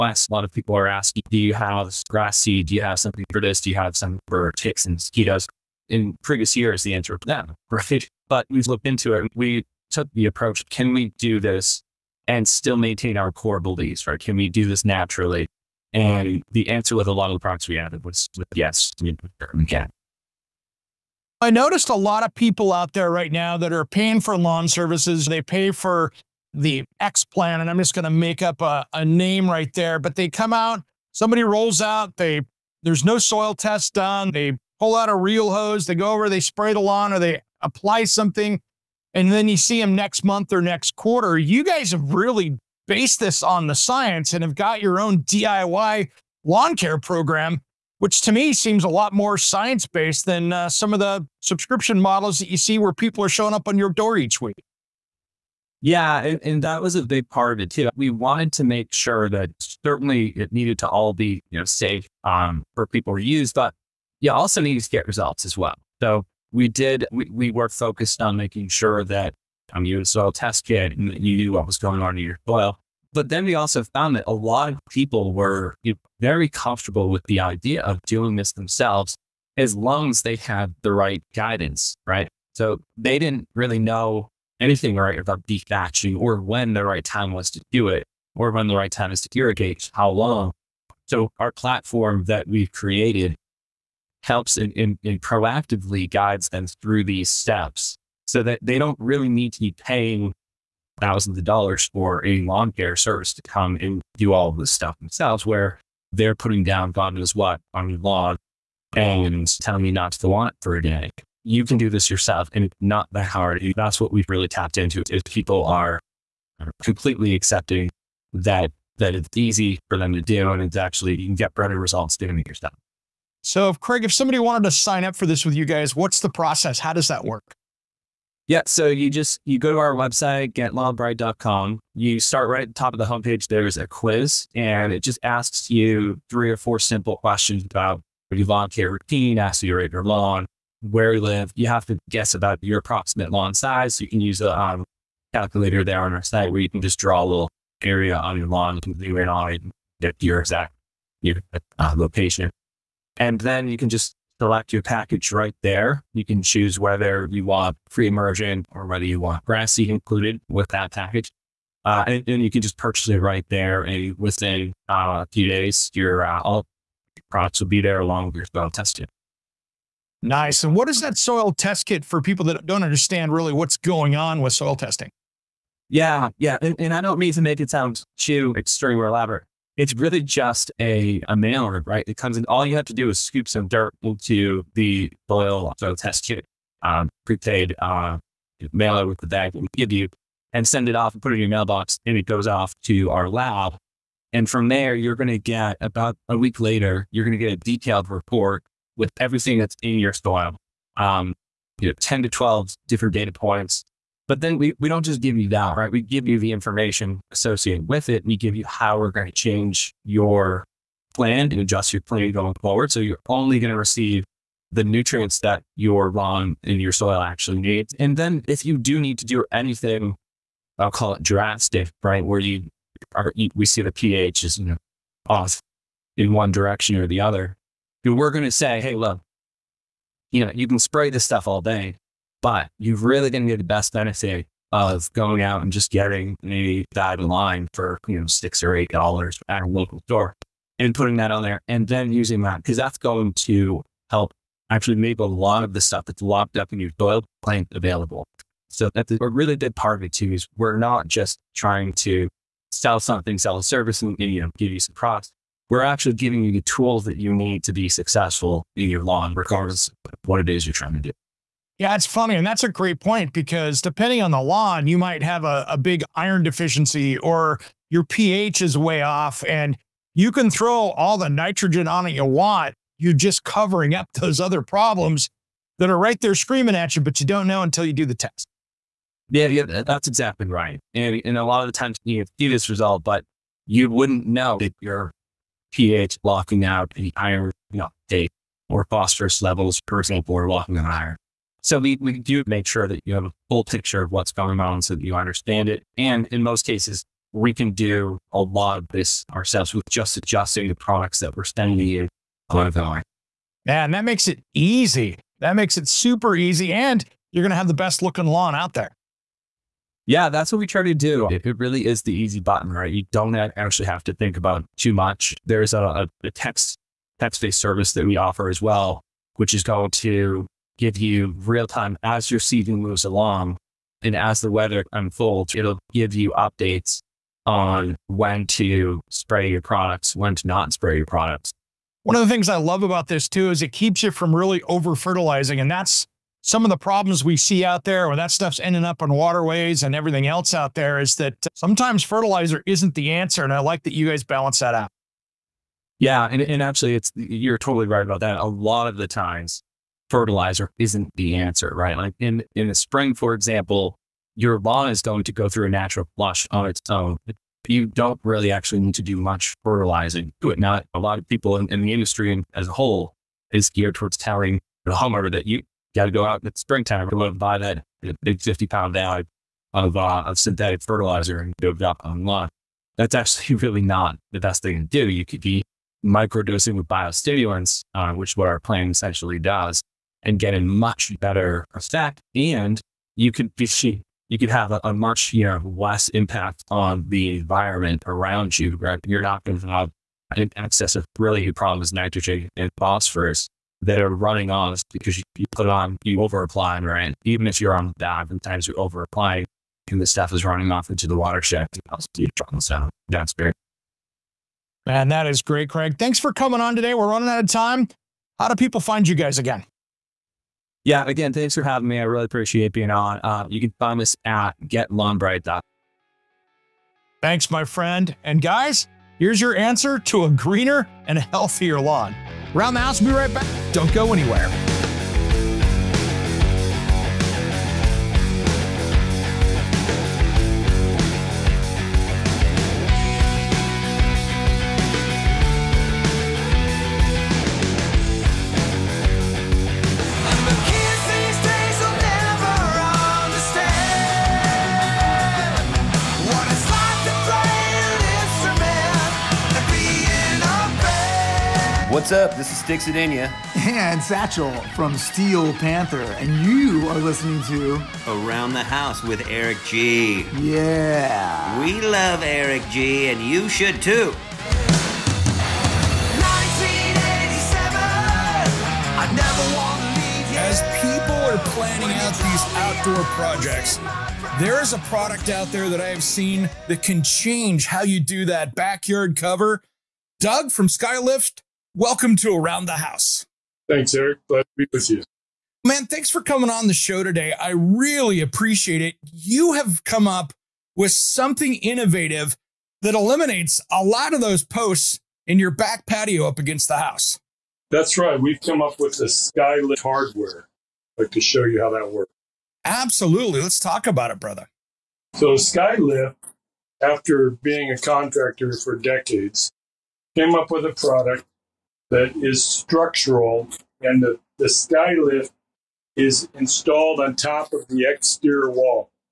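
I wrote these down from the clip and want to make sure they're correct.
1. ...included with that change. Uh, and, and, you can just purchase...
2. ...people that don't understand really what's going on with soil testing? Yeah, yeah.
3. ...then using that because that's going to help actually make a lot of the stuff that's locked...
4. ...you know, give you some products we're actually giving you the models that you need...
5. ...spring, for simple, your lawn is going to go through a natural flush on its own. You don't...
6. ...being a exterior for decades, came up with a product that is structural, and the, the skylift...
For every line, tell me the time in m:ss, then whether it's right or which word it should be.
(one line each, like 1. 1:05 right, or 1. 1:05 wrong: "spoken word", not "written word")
1. 2:39 wrong: "package", not "change"
2. 2:52 right
3. 4:01 right
4. 4:14 wrong: "tools", not "models"
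5. 5:52 wrong: "example", not "simple"
6. 8:27 wrong: "contractor", not "exterior".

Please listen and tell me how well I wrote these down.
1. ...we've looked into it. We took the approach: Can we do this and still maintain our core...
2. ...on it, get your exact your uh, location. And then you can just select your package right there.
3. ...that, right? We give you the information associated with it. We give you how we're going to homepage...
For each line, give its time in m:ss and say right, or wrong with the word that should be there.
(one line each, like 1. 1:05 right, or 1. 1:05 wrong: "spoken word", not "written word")
1. 0:08 right
2. 2:29 right
3. 3:25 wrong: "change", not "homepage".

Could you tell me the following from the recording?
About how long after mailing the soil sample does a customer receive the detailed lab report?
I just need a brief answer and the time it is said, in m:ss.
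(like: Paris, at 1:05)
About a week, at 3:15.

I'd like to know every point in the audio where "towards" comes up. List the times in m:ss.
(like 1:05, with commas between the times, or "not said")
6:03.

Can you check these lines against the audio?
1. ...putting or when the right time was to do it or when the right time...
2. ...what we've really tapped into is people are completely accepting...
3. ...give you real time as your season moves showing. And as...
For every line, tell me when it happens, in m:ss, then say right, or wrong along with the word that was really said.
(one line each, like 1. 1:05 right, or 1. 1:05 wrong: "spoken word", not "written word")
1. 1:25 wrong: "dethatching", not "putting"
2. 1:53 right
3. 5:20 wrong: "along", not "showing".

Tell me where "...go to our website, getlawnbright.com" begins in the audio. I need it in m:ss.
2:09.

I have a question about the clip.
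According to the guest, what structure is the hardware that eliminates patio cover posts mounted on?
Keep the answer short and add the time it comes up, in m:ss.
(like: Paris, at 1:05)
The exterior wall, at 8:37.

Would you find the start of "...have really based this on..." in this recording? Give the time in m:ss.
0:41.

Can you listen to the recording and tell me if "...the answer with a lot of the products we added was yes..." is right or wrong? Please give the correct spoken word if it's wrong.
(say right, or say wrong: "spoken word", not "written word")
right.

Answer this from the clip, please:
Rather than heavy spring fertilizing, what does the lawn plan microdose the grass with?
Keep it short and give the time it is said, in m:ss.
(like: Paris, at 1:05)
Biostimulants, at 6:16.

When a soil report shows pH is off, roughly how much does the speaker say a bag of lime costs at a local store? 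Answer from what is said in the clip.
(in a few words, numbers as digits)
$6 to $8.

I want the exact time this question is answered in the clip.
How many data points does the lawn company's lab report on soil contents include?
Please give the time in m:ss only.
3:21.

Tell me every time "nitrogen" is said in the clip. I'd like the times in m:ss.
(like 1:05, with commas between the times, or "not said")
4:31, 6:31.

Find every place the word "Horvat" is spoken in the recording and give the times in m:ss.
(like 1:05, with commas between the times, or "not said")
not said.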